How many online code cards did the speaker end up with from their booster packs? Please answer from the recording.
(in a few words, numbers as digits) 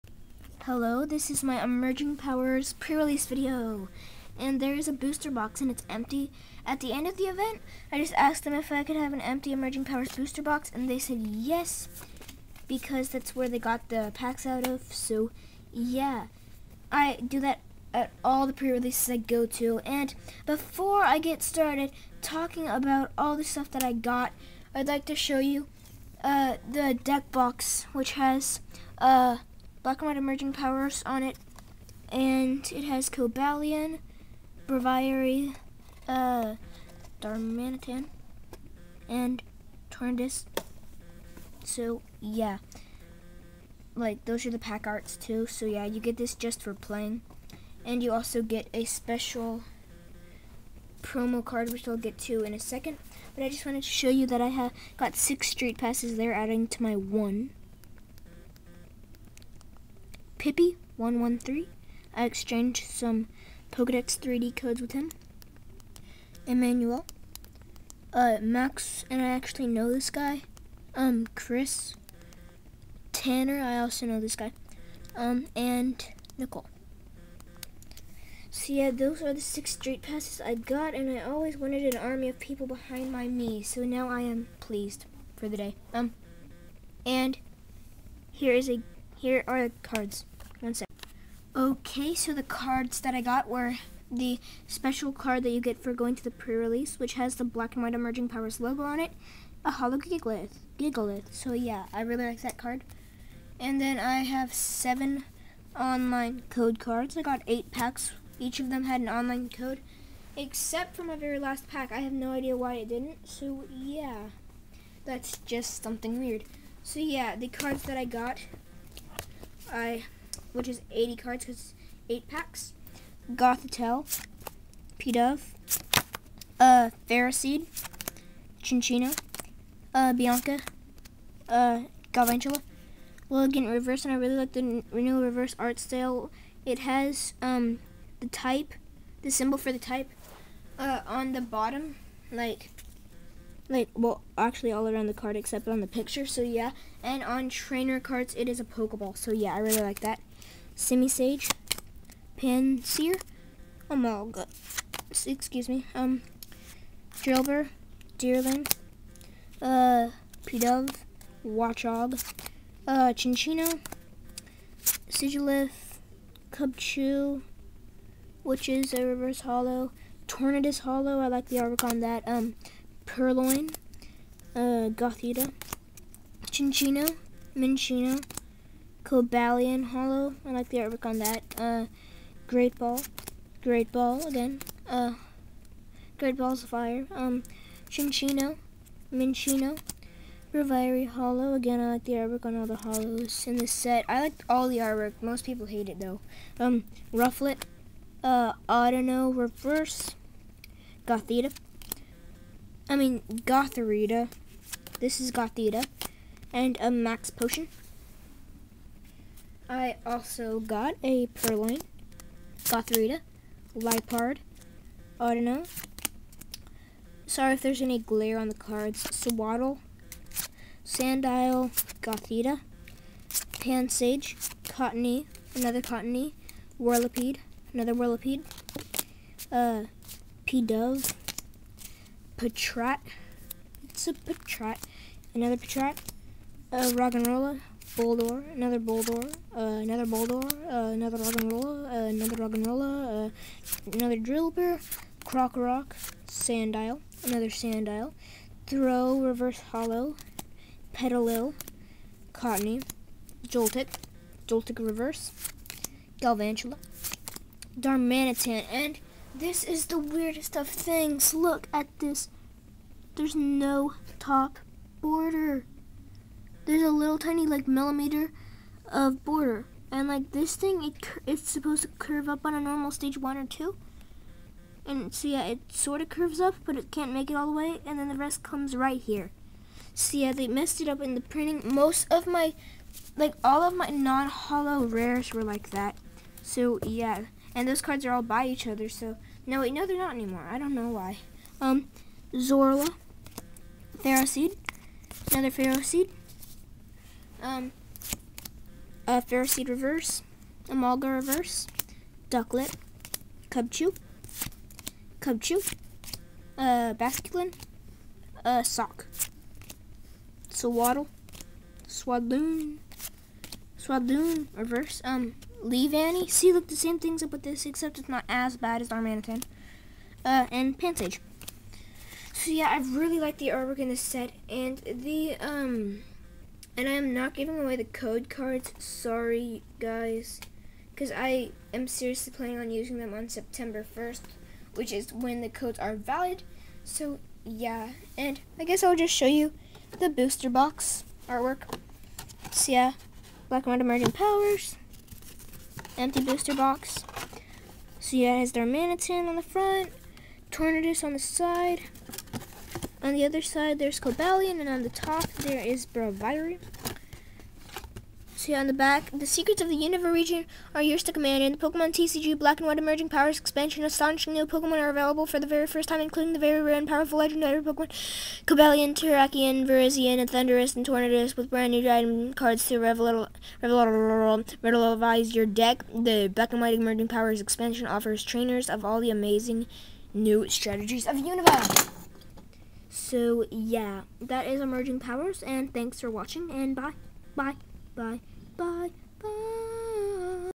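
7.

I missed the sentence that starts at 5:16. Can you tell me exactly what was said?
See, look, the same thing's up with this, except it's not as bad as Darmanitan.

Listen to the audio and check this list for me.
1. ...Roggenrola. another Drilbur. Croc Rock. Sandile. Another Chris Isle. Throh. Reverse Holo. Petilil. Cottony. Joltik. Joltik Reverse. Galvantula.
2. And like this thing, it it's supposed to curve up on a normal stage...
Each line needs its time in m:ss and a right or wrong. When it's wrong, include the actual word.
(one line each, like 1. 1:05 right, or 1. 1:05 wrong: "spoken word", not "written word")
1. 4:02 wrong: "Sand", not "Chris"
2. 4:29 right.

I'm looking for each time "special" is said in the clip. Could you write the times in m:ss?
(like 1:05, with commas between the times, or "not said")
0:48, 1:34.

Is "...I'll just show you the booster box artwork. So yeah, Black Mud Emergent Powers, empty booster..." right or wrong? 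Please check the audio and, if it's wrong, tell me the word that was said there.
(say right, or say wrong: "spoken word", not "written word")
right.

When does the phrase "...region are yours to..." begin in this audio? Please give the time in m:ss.
6:00.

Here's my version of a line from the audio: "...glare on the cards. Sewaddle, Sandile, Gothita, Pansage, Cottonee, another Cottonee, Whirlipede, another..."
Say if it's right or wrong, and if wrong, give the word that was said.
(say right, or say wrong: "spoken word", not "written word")
right.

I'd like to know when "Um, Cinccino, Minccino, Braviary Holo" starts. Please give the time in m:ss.
3:07.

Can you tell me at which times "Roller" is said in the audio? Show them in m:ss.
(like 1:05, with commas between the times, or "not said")
3:57.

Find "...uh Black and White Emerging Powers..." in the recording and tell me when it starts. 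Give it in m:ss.
0:28.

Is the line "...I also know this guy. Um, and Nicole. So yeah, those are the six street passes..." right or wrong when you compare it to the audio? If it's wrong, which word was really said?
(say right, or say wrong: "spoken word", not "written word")
right.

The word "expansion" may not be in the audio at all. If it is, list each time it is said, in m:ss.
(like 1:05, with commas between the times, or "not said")
6:03, 6:17.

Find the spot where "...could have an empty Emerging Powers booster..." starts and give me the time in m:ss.
0:08.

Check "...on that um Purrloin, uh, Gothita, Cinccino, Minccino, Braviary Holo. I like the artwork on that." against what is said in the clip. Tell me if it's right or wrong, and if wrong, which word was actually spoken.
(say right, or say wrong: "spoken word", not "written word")
wrong: "Cobalion", not "Braviary".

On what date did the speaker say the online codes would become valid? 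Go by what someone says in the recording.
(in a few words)
September 1.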